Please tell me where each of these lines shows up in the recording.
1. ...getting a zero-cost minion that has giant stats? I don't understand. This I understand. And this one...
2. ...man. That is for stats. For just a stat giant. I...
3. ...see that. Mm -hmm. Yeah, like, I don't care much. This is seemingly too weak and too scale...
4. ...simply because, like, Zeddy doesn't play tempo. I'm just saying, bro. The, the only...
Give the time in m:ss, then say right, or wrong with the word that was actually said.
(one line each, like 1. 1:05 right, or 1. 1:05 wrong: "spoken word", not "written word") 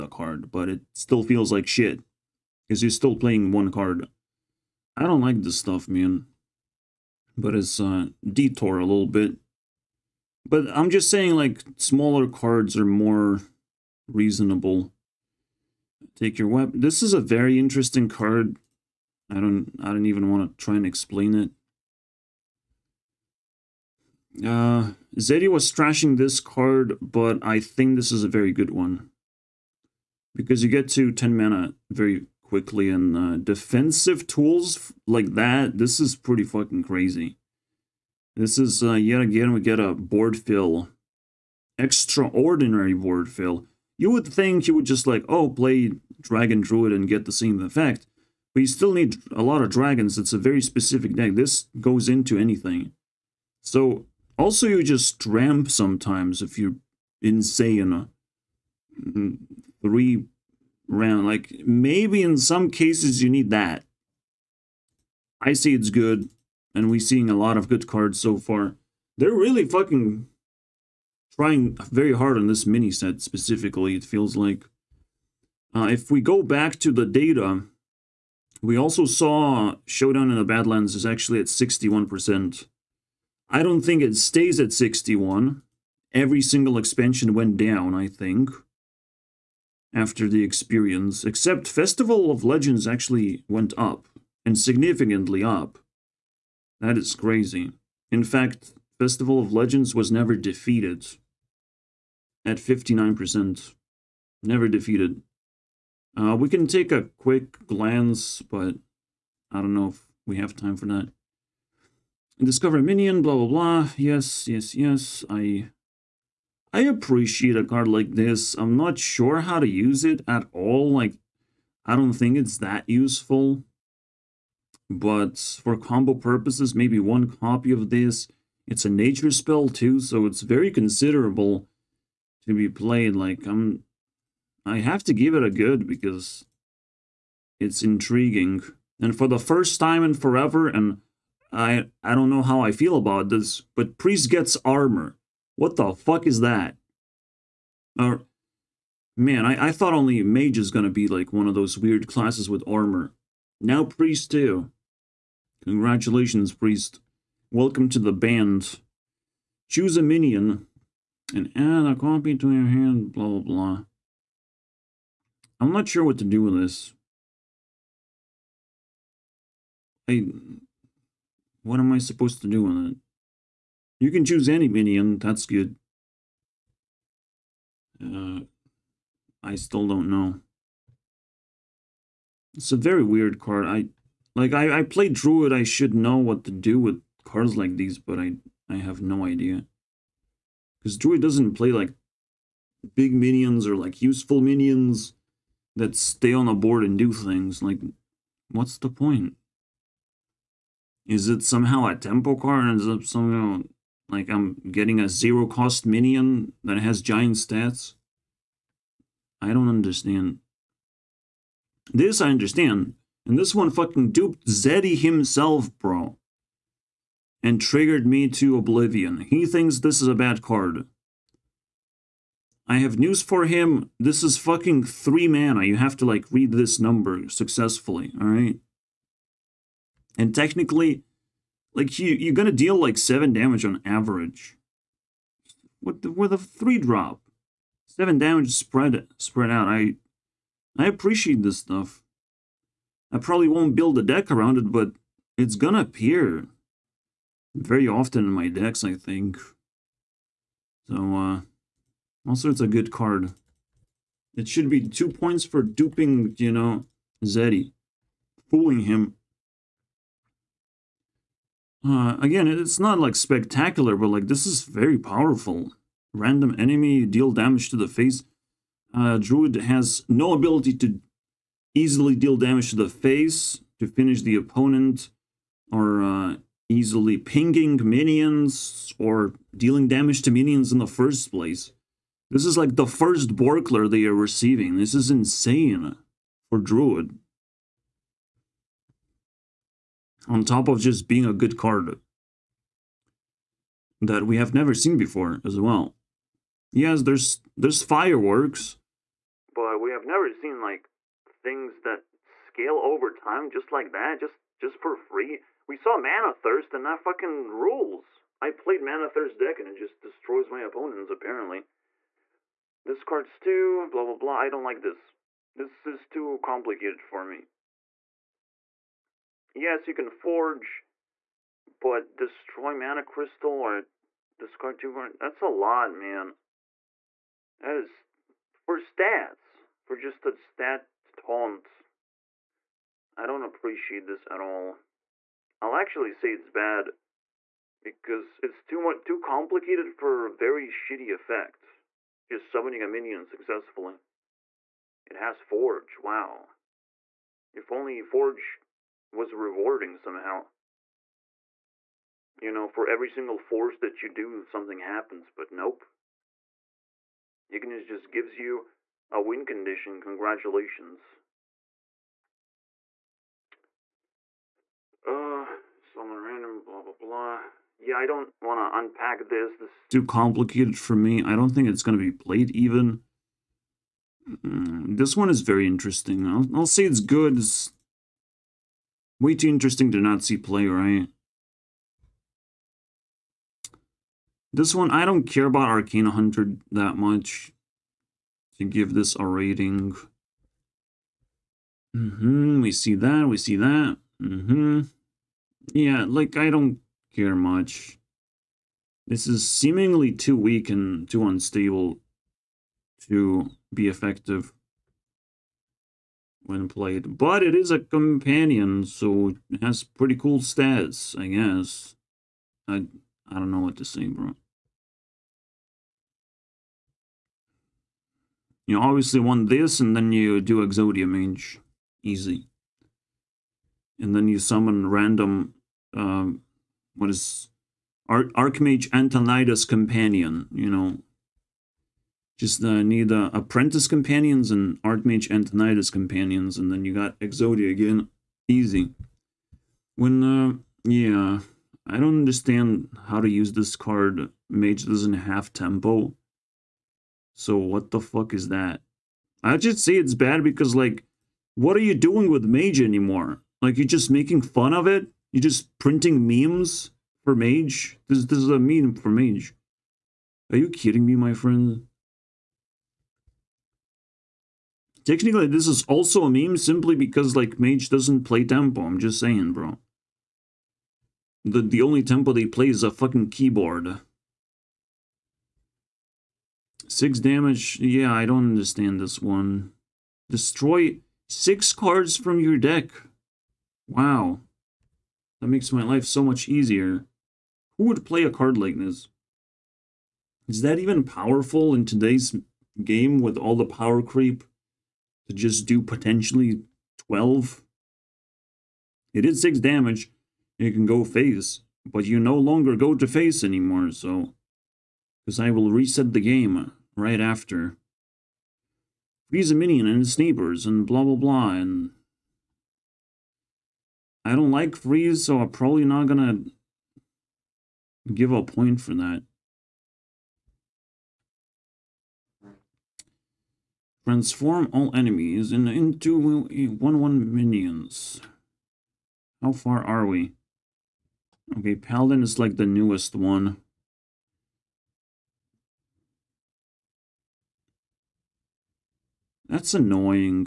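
1. 3:24 right
2. 5:25 wrong: "taunt", not "giant"
3. 6:33 wrong: "unstable", not "scale"
4. 7:46 wrong: "Mage", not "Zeddy".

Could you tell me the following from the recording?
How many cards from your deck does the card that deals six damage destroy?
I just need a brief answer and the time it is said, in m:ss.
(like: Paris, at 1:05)
6, at 8:01.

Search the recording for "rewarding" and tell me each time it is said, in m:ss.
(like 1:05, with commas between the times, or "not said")
5:49.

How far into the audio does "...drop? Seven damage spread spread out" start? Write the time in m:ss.
3:56.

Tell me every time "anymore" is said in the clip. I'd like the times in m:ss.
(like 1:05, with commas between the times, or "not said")
7:32, 8:23.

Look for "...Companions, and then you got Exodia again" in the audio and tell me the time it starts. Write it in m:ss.
7:15.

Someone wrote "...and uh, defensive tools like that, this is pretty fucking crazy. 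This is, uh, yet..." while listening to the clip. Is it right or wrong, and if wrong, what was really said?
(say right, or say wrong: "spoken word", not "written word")
right.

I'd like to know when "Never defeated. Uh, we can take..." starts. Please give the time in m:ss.
1:44.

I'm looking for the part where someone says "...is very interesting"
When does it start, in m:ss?
6:15.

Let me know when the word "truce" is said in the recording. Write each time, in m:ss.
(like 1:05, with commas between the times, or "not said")
not said.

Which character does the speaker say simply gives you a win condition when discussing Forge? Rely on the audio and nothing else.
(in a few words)
Ignis.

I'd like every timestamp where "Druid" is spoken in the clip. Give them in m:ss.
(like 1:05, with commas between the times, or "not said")
0:46, 3:05, 3:10, 4:29, 4:46.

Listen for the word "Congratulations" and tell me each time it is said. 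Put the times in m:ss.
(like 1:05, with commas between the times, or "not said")
2:35, 6:00.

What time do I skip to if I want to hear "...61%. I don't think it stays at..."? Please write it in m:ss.
1:21.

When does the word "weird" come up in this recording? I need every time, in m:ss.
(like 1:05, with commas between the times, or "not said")
2:31, 3:03.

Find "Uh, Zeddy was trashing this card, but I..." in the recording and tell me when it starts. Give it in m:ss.
0:24.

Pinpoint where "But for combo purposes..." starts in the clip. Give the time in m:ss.
2:04.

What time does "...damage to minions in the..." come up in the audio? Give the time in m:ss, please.
4:39.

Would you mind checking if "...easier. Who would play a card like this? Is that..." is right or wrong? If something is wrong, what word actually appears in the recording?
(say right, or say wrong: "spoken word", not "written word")
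right.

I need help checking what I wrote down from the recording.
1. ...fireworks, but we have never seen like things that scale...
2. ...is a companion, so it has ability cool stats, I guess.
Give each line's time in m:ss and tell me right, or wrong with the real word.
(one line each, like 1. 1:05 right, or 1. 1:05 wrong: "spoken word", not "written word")
1. 4:57 right
2. 6:47 wrong: "pretty", not "ability".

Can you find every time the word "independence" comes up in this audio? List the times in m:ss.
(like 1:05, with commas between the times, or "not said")
not said.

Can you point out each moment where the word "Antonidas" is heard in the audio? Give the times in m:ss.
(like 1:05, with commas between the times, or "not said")
7:08, 7:15.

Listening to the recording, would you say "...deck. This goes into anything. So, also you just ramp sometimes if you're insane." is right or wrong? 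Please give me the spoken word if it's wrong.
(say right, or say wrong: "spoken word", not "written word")
right.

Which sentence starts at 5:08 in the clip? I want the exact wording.
I played Mana Thirst deck and it just destroys my opponents, apparently.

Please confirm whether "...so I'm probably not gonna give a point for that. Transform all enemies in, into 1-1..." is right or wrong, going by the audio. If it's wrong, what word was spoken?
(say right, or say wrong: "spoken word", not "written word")
right.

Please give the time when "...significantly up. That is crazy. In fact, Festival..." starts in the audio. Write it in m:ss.
1:34.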